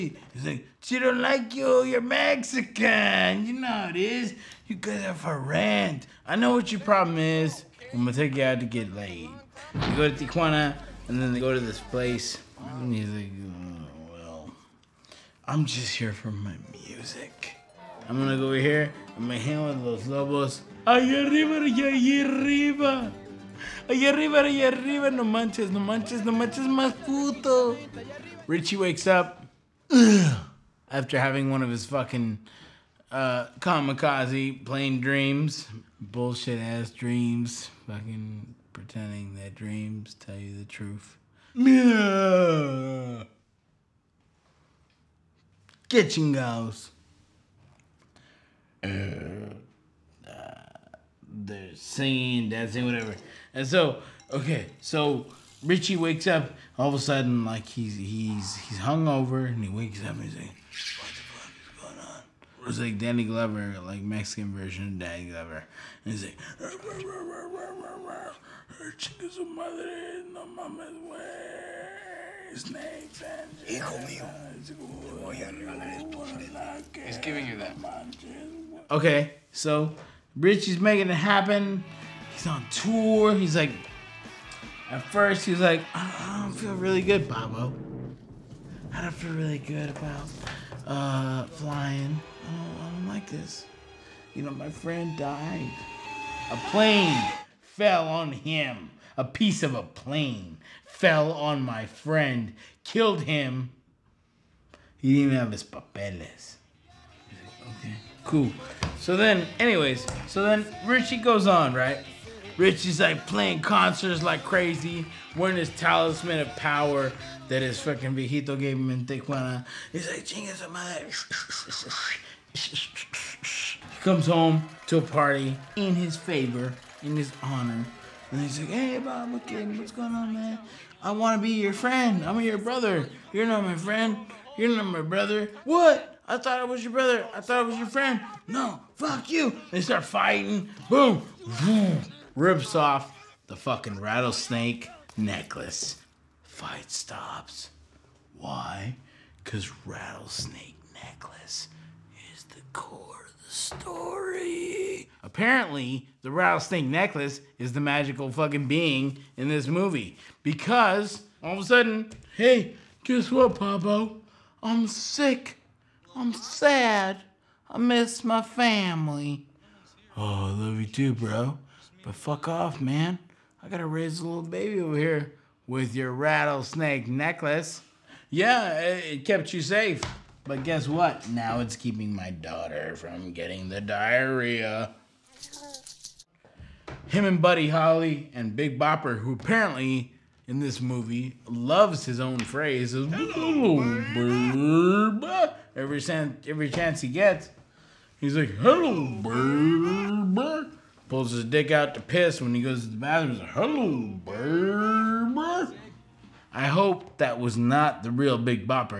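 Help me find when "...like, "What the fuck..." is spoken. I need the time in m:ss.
1:00.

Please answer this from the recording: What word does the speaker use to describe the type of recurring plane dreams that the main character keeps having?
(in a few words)
kamikaze.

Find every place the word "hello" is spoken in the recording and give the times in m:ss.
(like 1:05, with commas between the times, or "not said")
3:13, 3:18, 3:23.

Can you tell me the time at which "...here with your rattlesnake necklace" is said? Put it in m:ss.
2:54.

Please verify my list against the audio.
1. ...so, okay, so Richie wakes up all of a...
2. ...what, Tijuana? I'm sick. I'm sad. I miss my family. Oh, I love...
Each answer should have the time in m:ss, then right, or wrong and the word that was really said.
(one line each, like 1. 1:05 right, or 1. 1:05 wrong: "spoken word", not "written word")
1. 0:53 right
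2. 2:43 wrong: "Pablo", not "Tijuana".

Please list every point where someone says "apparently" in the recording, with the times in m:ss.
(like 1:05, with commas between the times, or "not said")
2:35, 3:09.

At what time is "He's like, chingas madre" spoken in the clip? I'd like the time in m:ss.
1:59.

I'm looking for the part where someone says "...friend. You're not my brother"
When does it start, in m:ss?
2:13.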